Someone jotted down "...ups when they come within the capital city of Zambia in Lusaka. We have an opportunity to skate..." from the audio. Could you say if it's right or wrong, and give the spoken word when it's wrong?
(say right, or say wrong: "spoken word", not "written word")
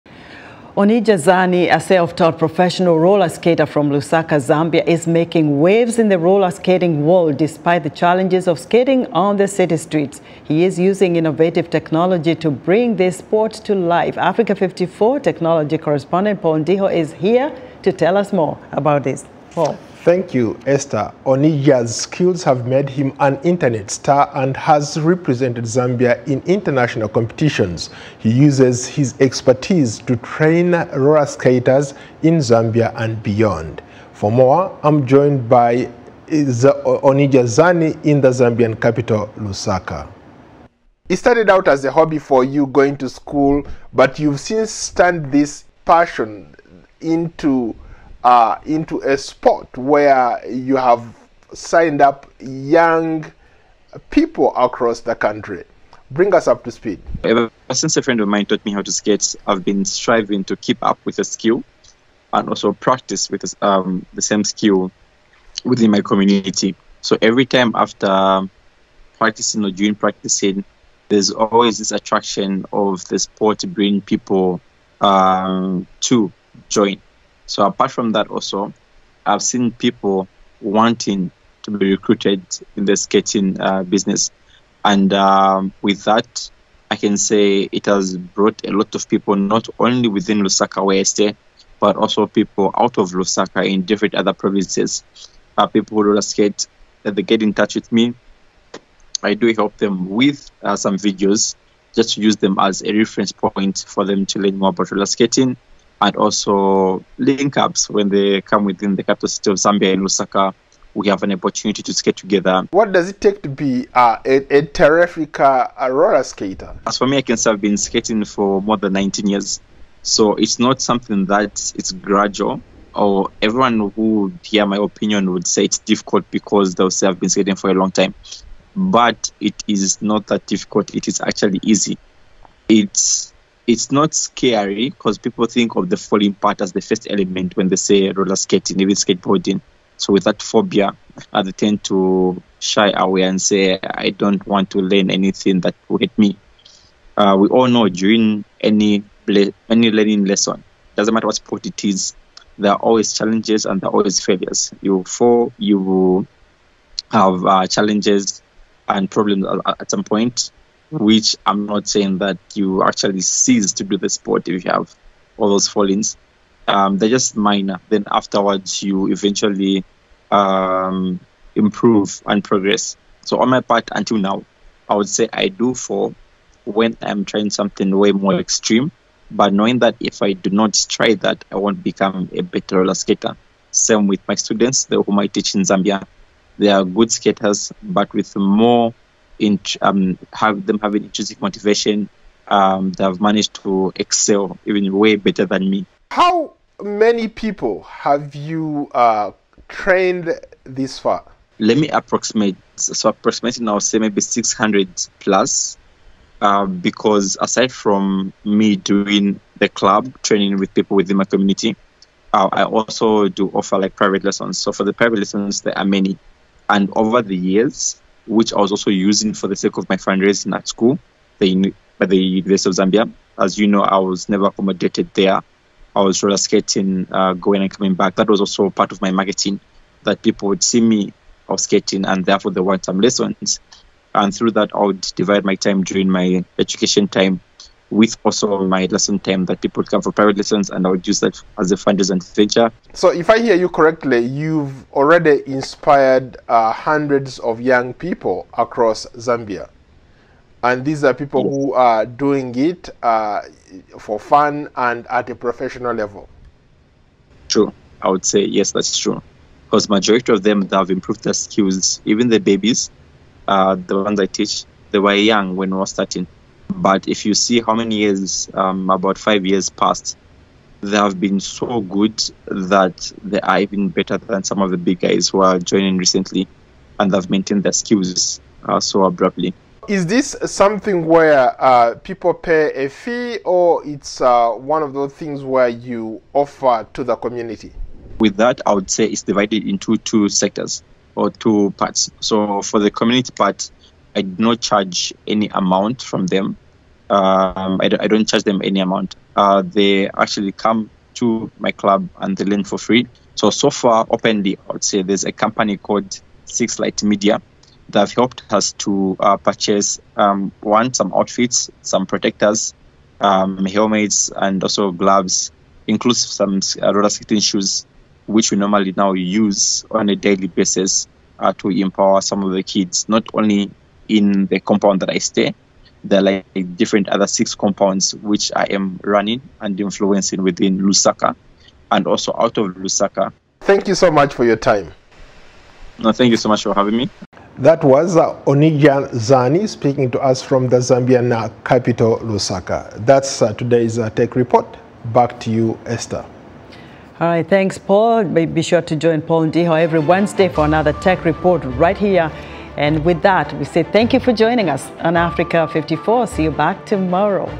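right.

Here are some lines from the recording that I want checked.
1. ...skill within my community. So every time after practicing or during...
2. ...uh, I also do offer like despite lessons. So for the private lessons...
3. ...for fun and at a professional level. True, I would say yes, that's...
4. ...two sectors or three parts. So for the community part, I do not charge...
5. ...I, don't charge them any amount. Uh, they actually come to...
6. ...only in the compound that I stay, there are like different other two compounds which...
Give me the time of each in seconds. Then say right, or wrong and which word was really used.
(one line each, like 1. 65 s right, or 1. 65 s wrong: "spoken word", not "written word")
1. 64 s right
2. 212 s wrong: "private", not "despite"
3. 253 s right
4. 289 s wrong: "two", not "three"
5. 297 s right
6. 323 s wrong: "six", not "two".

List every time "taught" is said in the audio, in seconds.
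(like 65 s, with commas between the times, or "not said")
1 s, 58 s.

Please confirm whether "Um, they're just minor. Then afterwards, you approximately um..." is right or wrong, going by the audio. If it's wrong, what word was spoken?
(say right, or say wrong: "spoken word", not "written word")
wrong: "eventually", not "approximately".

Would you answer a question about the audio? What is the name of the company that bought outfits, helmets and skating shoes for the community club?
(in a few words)
Six Light Media.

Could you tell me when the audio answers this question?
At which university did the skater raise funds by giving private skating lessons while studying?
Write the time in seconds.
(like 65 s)
222 s.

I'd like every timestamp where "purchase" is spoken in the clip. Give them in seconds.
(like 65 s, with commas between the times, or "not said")
309 s.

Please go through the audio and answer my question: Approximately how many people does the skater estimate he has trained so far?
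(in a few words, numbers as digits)
600.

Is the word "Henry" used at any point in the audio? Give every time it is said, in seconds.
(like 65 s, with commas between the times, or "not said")
not said.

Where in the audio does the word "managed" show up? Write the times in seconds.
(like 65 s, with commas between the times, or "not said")
193 s.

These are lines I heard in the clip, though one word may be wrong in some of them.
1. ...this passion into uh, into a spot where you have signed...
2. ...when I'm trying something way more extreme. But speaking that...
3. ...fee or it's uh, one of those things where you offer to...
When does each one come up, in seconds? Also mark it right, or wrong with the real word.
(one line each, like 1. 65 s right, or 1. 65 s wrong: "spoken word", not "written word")
1. 45 s right
2. 176 s wrong: "knowing", not "speaking"
3. 282 s right.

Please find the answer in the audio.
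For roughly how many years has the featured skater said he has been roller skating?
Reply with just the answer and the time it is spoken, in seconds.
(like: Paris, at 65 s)
19, at 118 s.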